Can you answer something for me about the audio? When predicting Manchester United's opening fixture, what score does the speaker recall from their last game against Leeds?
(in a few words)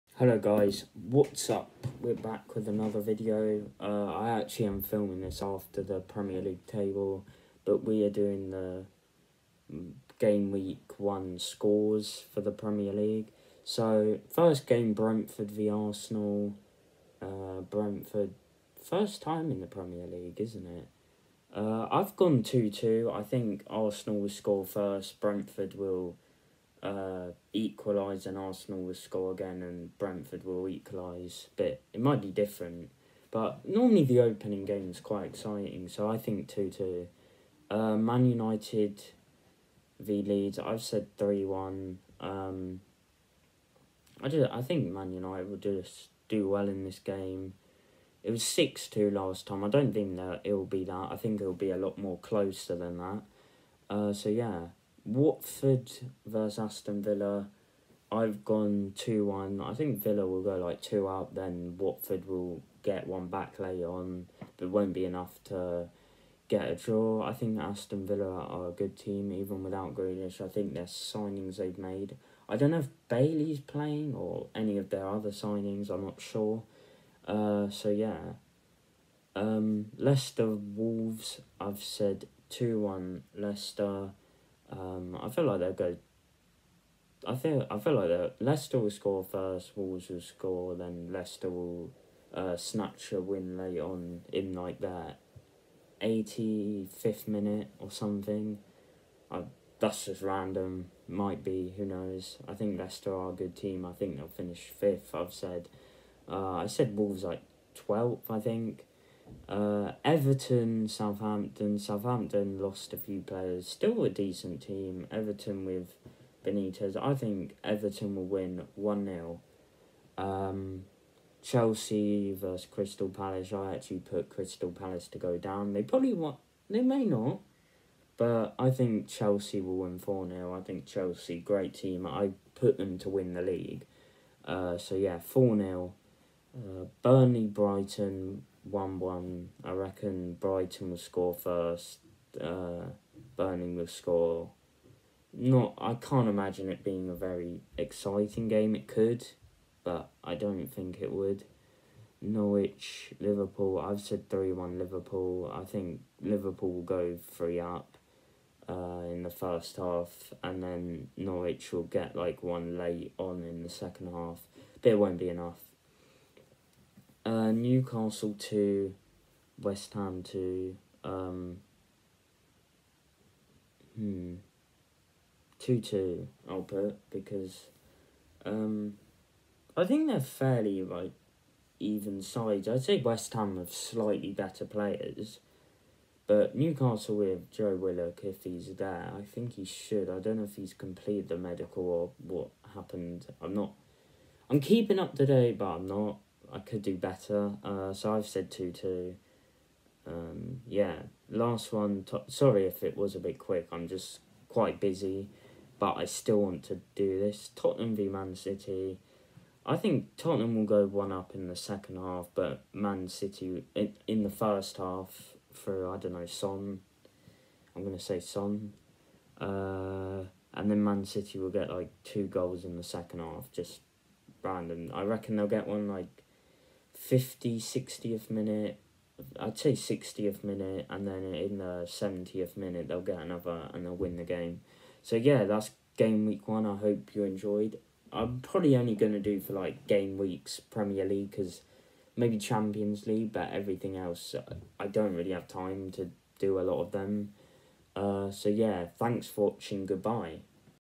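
6-2.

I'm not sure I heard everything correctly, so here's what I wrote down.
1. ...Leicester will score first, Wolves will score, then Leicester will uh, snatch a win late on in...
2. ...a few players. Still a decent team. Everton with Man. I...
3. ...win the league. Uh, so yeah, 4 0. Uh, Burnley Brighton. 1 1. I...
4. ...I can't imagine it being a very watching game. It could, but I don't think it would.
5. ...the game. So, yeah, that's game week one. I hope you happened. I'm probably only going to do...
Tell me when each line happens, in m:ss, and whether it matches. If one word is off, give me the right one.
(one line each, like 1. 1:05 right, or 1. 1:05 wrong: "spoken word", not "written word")
1. 1:28 right
2. 1:52 wrong: "Benitez", not "Man"
3. 2:13 right
4. 2:25 wrong: "exciting", not "watching"
5. 3:54 wrong: "enjoyed", not "happened".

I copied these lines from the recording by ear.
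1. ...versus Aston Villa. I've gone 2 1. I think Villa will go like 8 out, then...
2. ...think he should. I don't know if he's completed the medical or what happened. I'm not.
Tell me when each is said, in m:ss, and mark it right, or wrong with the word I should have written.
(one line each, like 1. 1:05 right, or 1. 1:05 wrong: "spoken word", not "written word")
1. 0:56 wrong: "2", not "8"
2. 3:09 right.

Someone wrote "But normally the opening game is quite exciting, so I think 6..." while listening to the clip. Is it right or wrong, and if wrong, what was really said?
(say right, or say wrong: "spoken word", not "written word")
wrong: "2", not "6".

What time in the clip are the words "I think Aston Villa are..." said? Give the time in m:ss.
1:07.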